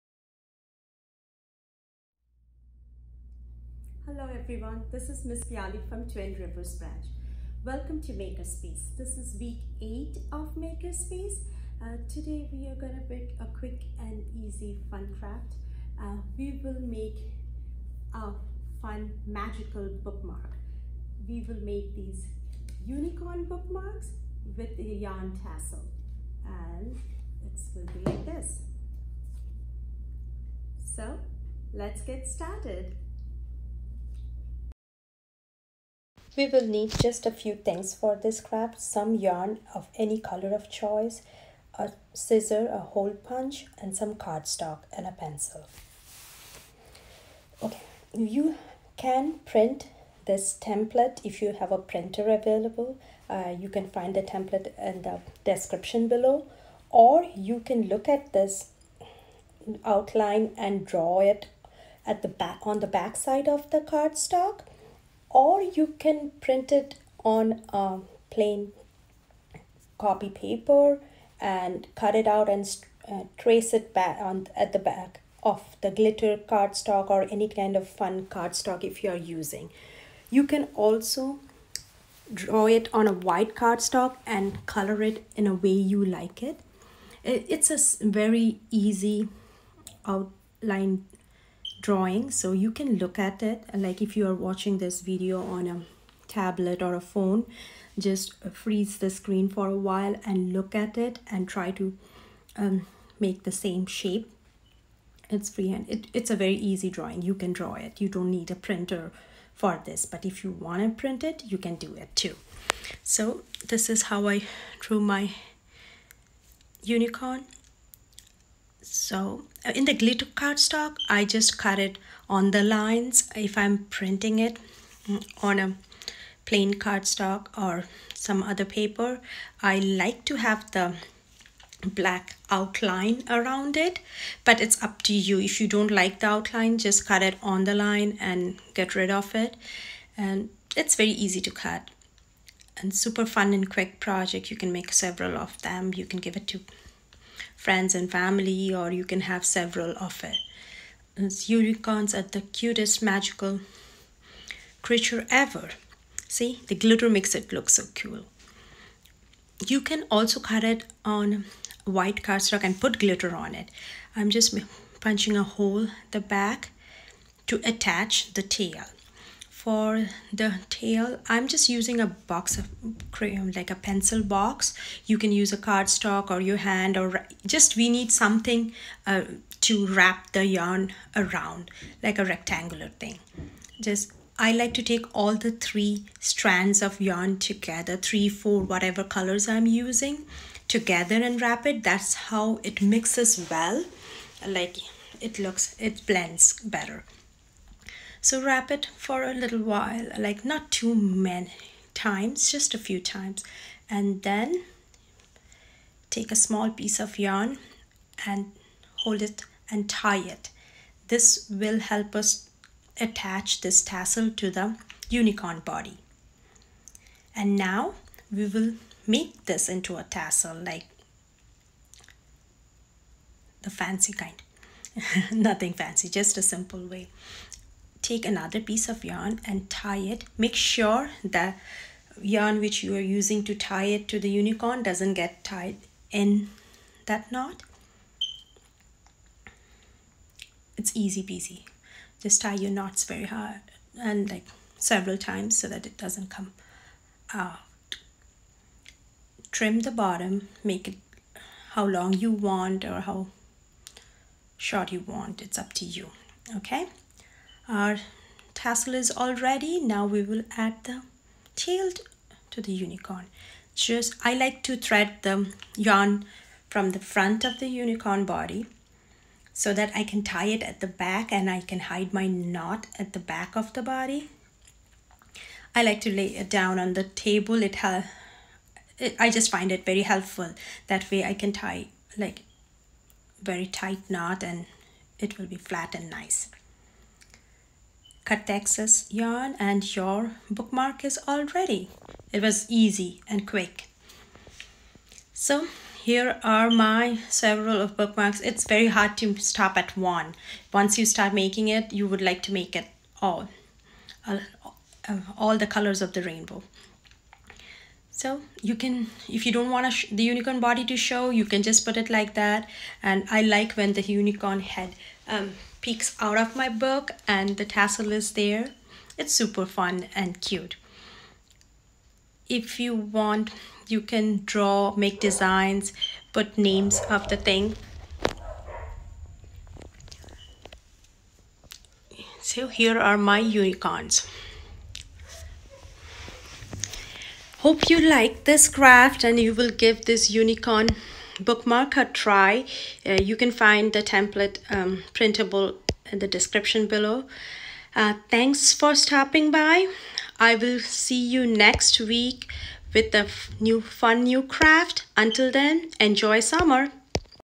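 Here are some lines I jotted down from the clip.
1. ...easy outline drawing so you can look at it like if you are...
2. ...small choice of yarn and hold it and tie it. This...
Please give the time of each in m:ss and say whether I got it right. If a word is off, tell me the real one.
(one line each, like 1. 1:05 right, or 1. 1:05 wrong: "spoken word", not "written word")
1. 1:28 right
2. 3:26 wrong: "piece", not "choice".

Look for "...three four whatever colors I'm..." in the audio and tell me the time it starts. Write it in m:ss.
3:07.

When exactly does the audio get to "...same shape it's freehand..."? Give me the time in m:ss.
1:43.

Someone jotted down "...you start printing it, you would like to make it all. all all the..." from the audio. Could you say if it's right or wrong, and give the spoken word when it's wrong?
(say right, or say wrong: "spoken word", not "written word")
wrong: "making", not "printing".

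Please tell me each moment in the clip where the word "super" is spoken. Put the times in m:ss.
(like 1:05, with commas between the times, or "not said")
2:22, 5:19.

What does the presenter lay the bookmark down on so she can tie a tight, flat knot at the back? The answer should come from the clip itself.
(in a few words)
The table.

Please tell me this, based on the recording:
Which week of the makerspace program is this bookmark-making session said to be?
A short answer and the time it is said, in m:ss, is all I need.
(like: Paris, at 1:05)
Week 8, at 0:09.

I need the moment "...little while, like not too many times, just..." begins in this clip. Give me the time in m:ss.
3:19.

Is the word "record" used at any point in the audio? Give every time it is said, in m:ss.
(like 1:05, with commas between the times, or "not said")
not said.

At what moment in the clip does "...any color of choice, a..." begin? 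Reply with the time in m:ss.
0:39.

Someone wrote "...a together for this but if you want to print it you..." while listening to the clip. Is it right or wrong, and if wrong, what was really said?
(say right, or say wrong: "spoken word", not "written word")
wrong: "printer", not "together".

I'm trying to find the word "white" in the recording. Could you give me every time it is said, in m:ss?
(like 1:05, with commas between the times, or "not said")
1:23, 2:41.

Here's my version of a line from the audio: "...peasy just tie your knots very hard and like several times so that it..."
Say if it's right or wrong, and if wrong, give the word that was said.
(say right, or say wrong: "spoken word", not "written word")
right.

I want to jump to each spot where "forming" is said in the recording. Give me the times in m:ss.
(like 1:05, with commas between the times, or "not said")
not said.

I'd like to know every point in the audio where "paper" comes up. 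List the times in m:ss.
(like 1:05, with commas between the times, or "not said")
1:10, 2:08.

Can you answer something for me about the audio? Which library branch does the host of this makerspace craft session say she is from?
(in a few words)
Twin Rivers Branch.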